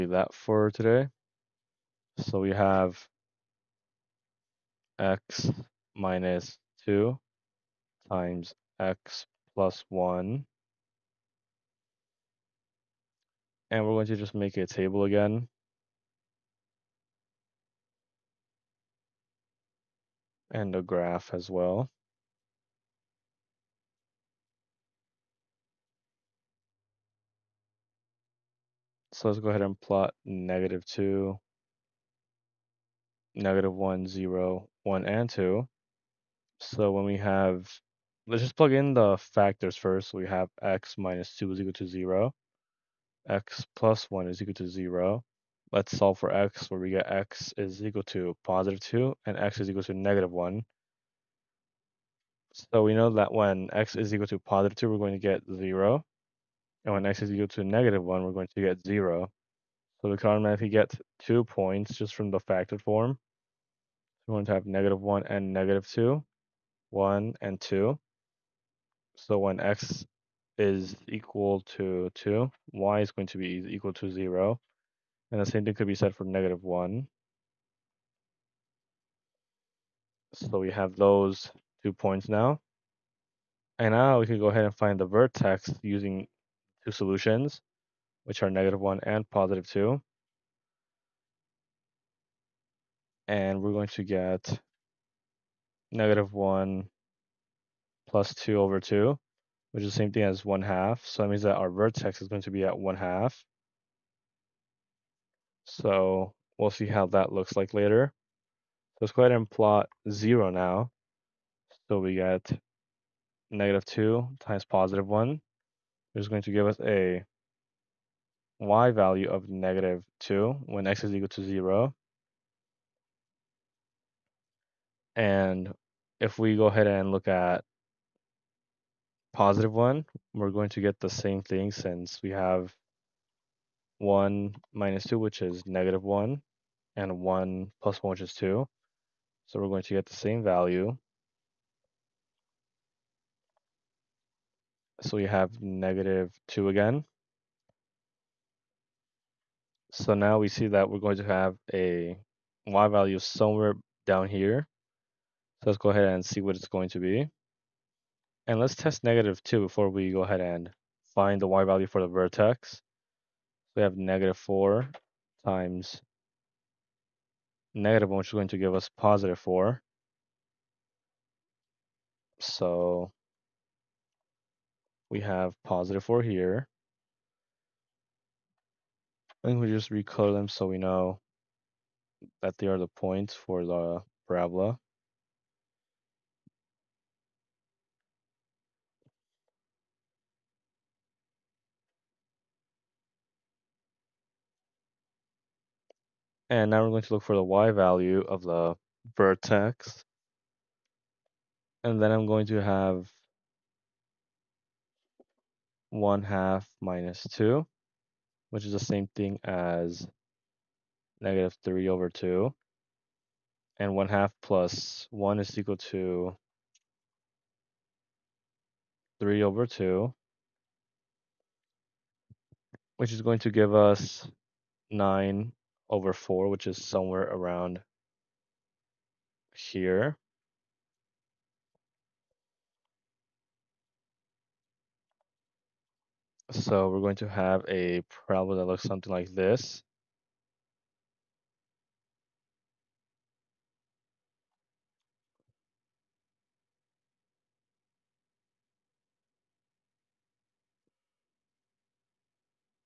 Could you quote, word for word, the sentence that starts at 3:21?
And then I'm going to have 1 half minus 2, which is the same thing as negative 3 over 2.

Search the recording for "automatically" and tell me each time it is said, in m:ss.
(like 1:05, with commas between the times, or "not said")
1:00.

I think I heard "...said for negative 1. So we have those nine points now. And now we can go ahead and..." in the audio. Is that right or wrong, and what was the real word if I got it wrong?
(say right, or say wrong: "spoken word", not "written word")
wrong: "two", not "nine".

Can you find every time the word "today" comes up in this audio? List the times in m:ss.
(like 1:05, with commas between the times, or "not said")
0:00.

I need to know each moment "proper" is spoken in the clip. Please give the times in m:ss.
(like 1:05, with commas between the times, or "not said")
not said.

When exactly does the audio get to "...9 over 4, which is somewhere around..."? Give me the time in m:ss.
3:44.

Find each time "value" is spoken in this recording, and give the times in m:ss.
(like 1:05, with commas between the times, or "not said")
1:58, 2:20, 2:32, 2:41, 3:17.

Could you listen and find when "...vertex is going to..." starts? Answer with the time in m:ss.
1:41.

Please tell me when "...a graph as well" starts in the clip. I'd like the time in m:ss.
0:20.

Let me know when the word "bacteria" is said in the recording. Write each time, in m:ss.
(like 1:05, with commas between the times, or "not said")
not said.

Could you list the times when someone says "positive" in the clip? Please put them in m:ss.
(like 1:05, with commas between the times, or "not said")
0:48, 0:54, 1:29, 1:54, 2:09, 2:48, 2:55.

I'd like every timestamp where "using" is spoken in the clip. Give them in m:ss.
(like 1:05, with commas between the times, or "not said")
1:25.